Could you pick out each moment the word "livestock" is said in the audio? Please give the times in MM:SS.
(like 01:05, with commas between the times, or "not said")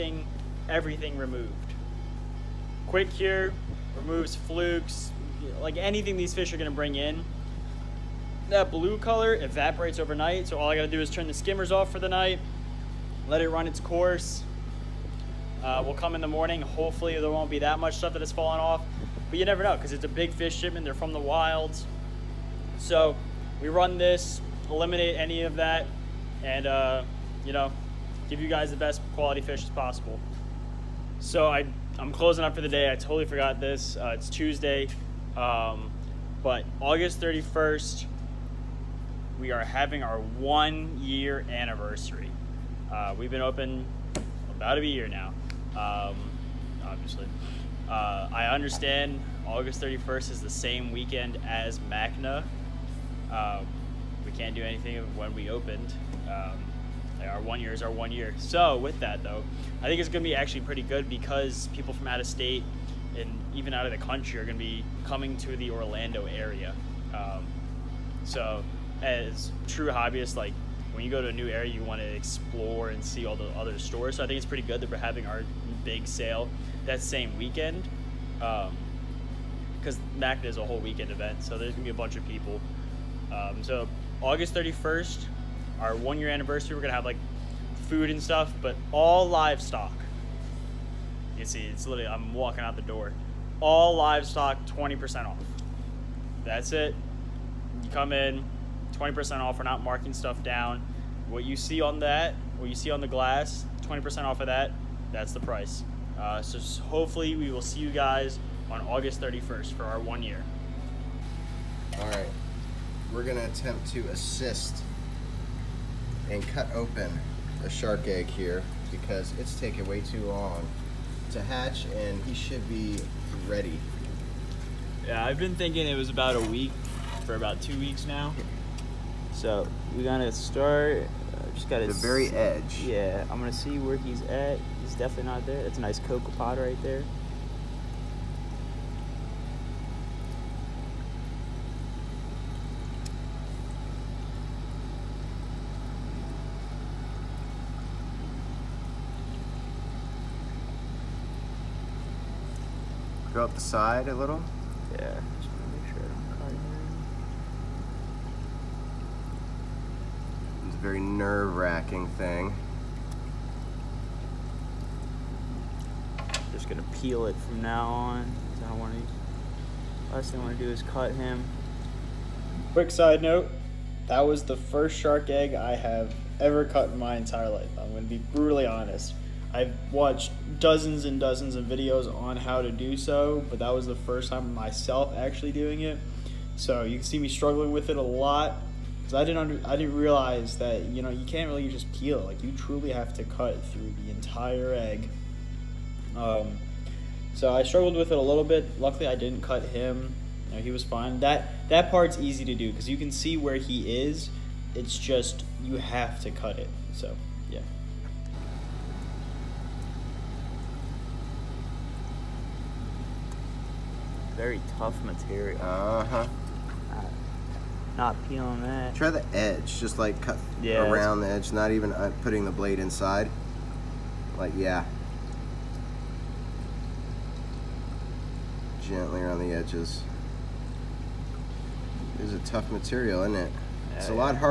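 01:29, 01:33.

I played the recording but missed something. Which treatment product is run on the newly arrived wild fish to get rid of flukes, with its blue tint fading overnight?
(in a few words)
Quick Cure.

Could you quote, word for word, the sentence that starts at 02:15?
That's a nice cocoa pod right there.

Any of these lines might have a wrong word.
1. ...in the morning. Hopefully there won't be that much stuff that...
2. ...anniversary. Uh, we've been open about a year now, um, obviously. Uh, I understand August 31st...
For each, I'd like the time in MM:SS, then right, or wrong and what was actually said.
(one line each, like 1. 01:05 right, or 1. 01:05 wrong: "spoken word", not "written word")
1. 00:16 right
2. 00:41 right.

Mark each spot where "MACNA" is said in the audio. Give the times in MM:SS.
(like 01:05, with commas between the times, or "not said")
00:51, 01:20.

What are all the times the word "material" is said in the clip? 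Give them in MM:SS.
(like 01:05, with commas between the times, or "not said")
03:35, 03:52.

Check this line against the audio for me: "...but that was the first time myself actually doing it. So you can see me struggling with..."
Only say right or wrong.
right.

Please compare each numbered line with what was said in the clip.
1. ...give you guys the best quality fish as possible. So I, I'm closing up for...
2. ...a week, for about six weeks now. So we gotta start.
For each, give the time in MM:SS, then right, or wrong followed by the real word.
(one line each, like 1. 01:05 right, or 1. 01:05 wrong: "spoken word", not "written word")
1. 00:28 right
2. 02:06 wrong: "two", not "six".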